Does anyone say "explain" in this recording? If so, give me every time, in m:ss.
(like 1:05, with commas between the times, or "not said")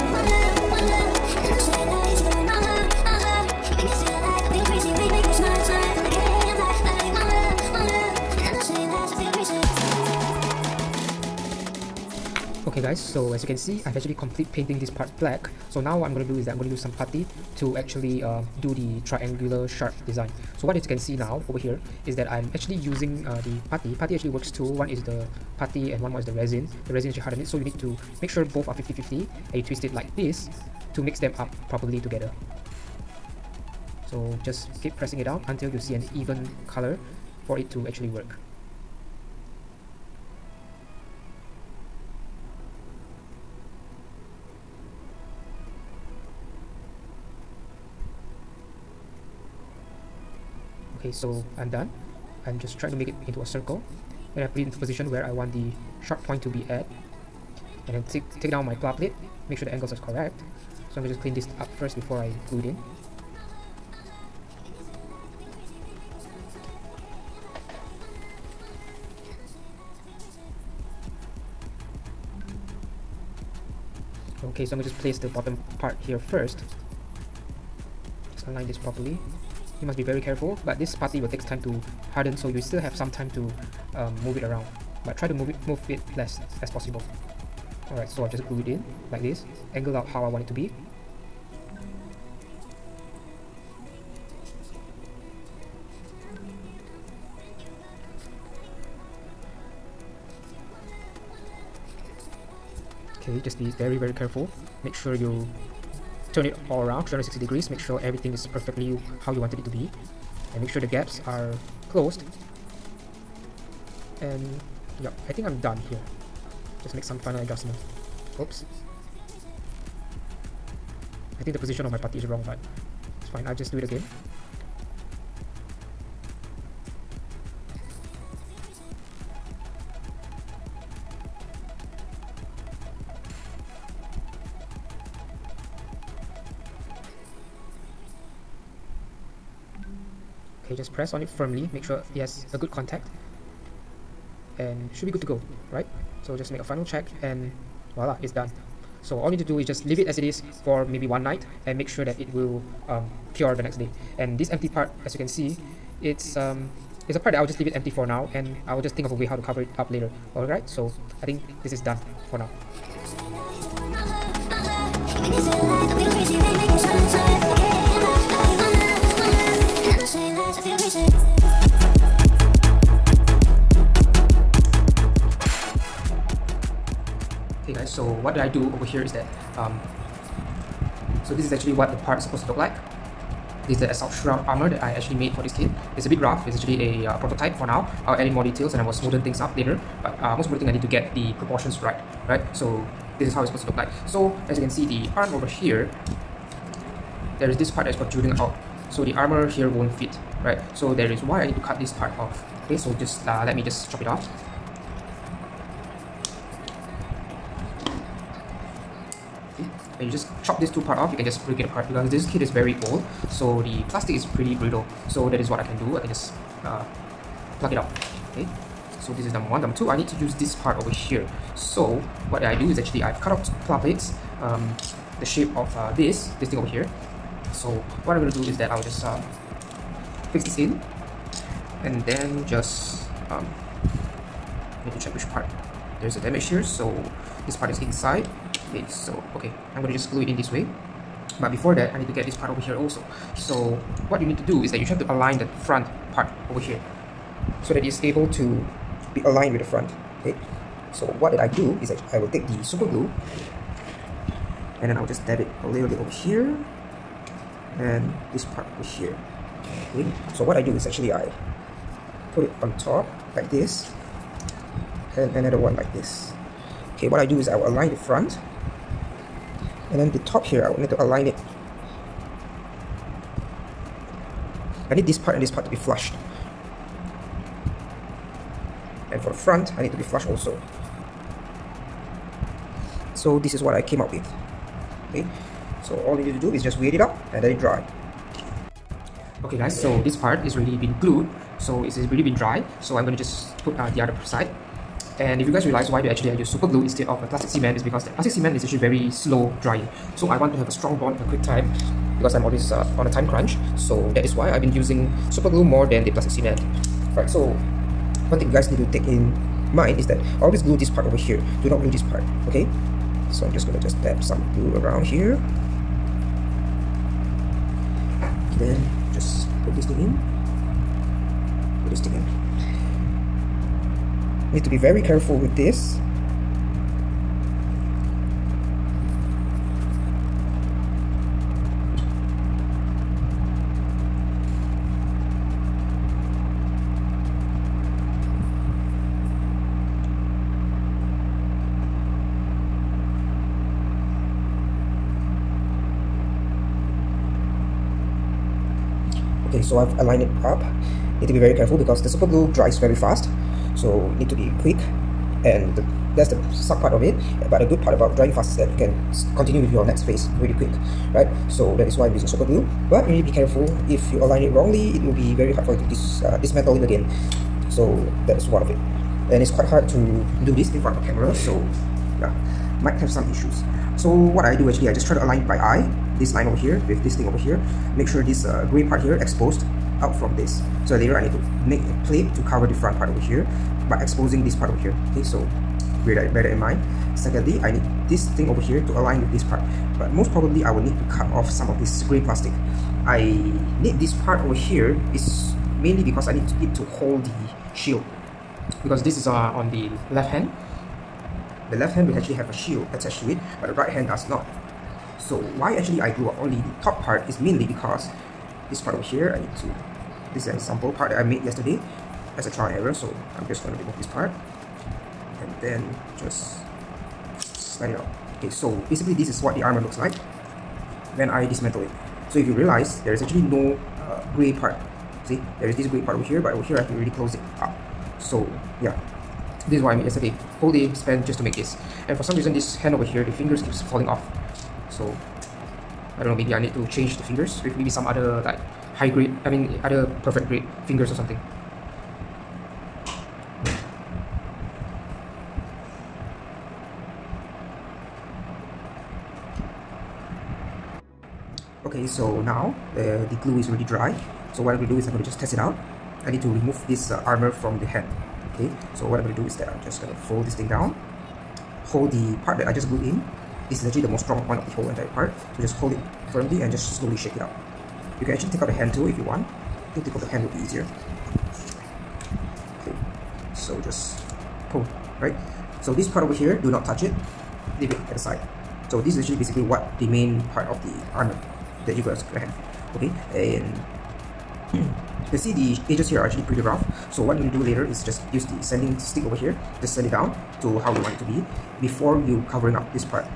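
not said.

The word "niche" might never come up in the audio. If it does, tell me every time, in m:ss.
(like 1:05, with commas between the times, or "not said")
not said.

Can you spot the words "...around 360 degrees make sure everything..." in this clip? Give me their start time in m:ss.
1:46.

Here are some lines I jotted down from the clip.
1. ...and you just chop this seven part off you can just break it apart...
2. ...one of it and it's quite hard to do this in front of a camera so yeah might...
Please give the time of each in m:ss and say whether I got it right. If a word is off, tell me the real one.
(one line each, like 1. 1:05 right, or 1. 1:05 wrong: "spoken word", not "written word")
1. 3:29 wrong: "two", not "seven"
2. 6:08 right.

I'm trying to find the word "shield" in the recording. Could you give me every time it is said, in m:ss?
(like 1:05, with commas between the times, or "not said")
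6:37, 6:42.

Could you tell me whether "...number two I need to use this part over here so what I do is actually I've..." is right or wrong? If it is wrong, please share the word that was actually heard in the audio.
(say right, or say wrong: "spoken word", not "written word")
right.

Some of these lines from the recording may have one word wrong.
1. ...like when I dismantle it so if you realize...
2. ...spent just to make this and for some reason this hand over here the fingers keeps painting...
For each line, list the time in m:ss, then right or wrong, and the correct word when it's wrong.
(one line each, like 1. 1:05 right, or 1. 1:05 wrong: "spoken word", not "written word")
1. 6:59 right
2. 7:10 wrong: "falling", not "painting".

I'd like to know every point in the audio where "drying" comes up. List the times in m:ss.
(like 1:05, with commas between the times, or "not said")
4:59, 5:58.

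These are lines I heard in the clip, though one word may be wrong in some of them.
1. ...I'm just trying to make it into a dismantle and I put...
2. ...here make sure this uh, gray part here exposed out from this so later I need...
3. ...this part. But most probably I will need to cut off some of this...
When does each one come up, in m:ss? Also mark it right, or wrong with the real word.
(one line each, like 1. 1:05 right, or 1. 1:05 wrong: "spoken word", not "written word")
1. 0:52 wrong: "circle", not "dismantle"
2. 6:17 right
3. 6:29 right.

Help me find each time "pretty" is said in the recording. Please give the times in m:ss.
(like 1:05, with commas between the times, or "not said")
3:34, 8:06.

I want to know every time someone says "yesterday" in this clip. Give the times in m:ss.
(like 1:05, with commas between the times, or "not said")
6:51, 7:10.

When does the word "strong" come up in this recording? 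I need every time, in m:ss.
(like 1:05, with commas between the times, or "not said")
5:00, 7:44.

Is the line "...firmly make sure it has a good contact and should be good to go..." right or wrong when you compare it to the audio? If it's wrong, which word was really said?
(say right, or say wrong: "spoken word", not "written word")
right.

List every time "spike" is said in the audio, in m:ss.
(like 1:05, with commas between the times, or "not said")
not said.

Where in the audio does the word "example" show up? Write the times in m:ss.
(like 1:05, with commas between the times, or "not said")
6:50.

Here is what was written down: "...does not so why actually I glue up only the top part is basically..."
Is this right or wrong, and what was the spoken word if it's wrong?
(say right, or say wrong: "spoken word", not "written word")
wrong: "mainly", not "basically".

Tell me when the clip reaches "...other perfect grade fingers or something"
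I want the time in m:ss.
7:19.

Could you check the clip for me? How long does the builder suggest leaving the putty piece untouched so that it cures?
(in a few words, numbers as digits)
one night.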